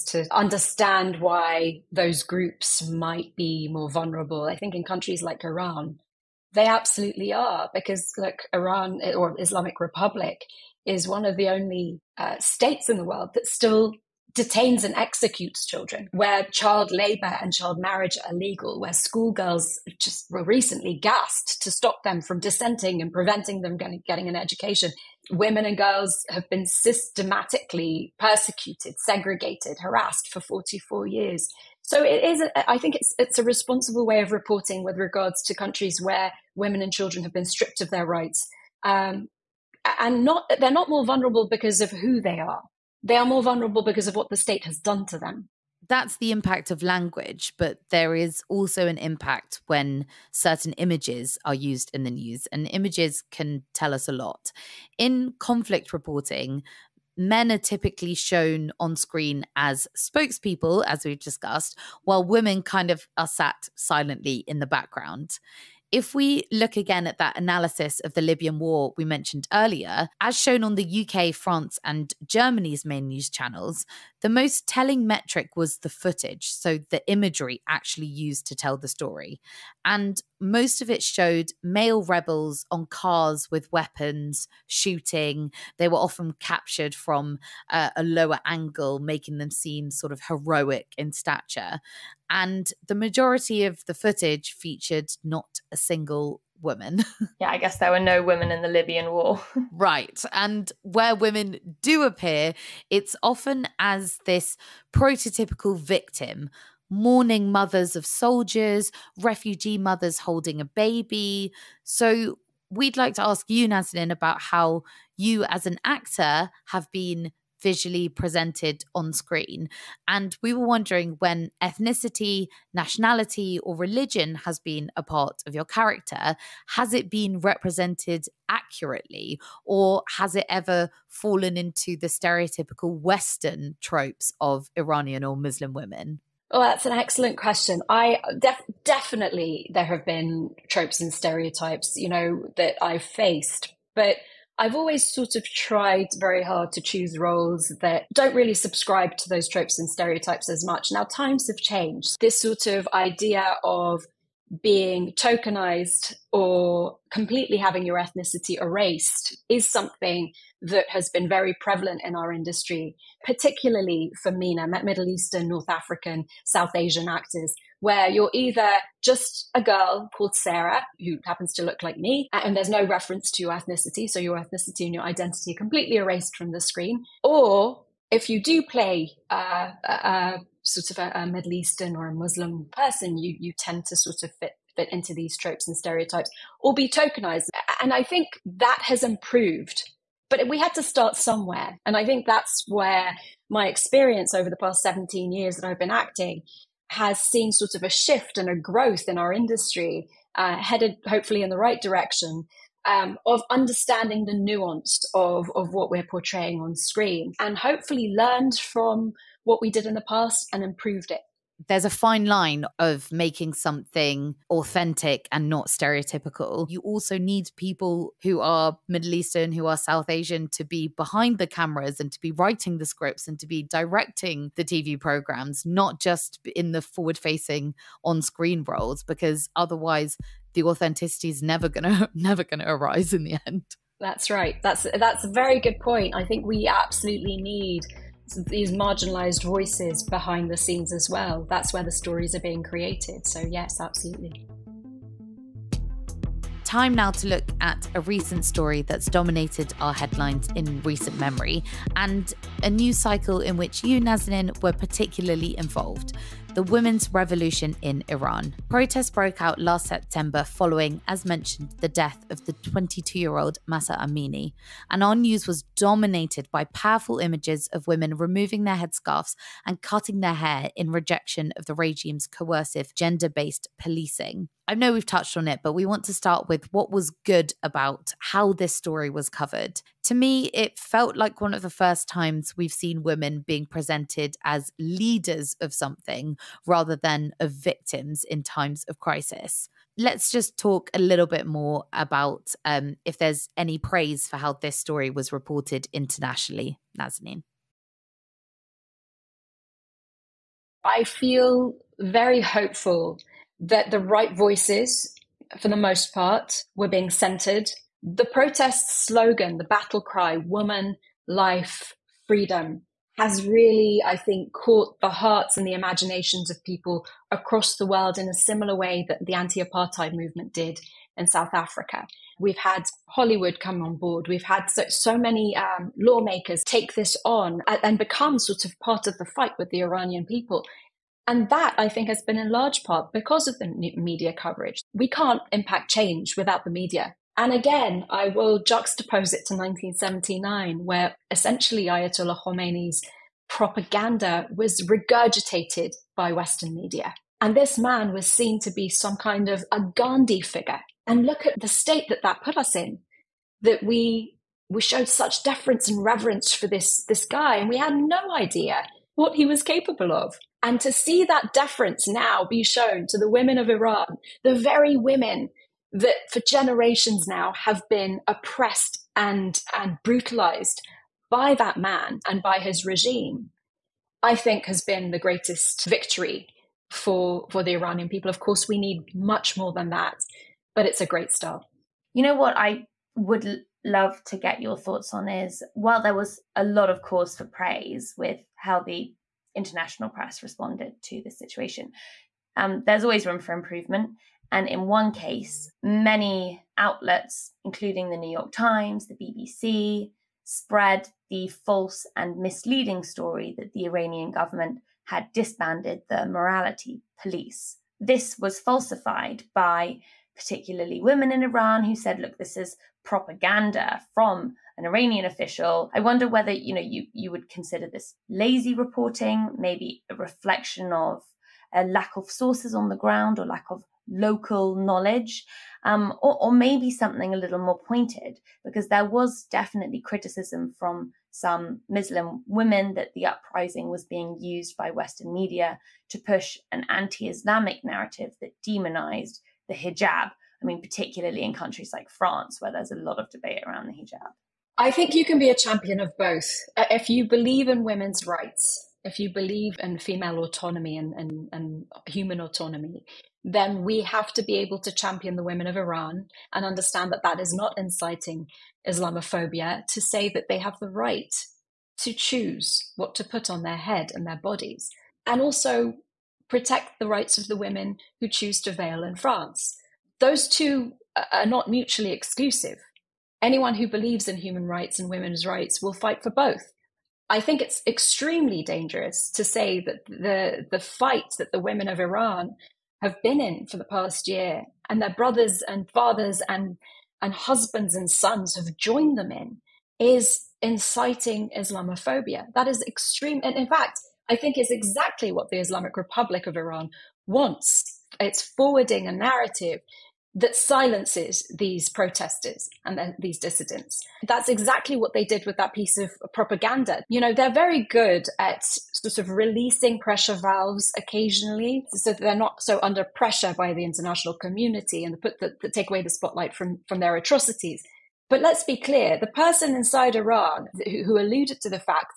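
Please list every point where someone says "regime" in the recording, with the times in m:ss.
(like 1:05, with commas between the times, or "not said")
4:31, 6:12.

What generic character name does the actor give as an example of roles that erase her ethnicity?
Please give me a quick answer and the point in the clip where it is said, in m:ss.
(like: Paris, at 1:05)
Sarah, at 2:50.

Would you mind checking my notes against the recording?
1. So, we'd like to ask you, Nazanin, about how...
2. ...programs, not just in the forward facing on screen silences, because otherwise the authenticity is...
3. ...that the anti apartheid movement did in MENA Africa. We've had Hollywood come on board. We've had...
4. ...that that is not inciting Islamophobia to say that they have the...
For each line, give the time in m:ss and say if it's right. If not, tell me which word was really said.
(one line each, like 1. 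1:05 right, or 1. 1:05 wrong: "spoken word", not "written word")
1. 1:51 right
2. 3:45 wrong: "roles", not "silences"
3. 5:19 wrong: "South", not "MENA"
4. 7:37 right.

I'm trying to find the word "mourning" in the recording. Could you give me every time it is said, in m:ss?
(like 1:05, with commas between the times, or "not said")
1:46.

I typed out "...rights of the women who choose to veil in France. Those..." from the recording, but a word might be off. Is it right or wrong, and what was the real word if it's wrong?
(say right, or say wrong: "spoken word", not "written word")
right.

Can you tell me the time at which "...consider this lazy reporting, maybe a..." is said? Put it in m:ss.
6:57.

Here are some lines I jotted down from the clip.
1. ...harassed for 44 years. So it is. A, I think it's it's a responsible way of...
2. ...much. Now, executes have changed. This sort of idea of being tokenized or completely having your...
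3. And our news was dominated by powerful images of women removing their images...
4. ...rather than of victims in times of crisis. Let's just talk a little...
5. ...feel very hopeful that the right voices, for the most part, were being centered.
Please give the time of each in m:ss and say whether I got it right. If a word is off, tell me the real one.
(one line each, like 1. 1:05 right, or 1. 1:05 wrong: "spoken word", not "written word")
1. 0:29 right
2. 2:30 wrong: "times", not "executes"
3. 4:24 wrong: "headscarves", not "images"
4. 4:46 right
5. 5:01 right.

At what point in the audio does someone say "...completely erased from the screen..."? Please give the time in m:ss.
2:55.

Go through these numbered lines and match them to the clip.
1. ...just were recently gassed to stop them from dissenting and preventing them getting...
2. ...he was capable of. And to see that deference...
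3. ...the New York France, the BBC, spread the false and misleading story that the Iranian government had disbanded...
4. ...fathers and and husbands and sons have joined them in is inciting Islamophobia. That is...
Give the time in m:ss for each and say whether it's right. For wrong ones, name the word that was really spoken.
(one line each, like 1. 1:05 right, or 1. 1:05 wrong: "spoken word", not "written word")
1. 0:19 right
2. 5:59 right
3. 6:38 wrong: "Times", not "France"
4. 8:05 right.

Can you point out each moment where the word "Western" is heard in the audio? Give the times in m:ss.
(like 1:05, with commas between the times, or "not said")
2:12, 5:46, 7:14.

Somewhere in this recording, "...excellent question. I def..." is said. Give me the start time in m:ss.
2:16.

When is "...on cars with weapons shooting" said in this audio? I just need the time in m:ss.
1:22.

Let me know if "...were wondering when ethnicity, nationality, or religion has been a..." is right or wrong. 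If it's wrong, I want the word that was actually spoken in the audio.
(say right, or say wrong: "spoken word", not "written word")
right.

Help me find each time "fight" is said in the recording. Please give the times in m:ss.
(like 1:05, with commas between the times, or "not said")
5:29, 7:55, 8:00.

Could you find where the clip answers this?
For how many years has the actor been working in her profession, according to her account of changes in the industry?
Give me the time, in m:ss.
3:14.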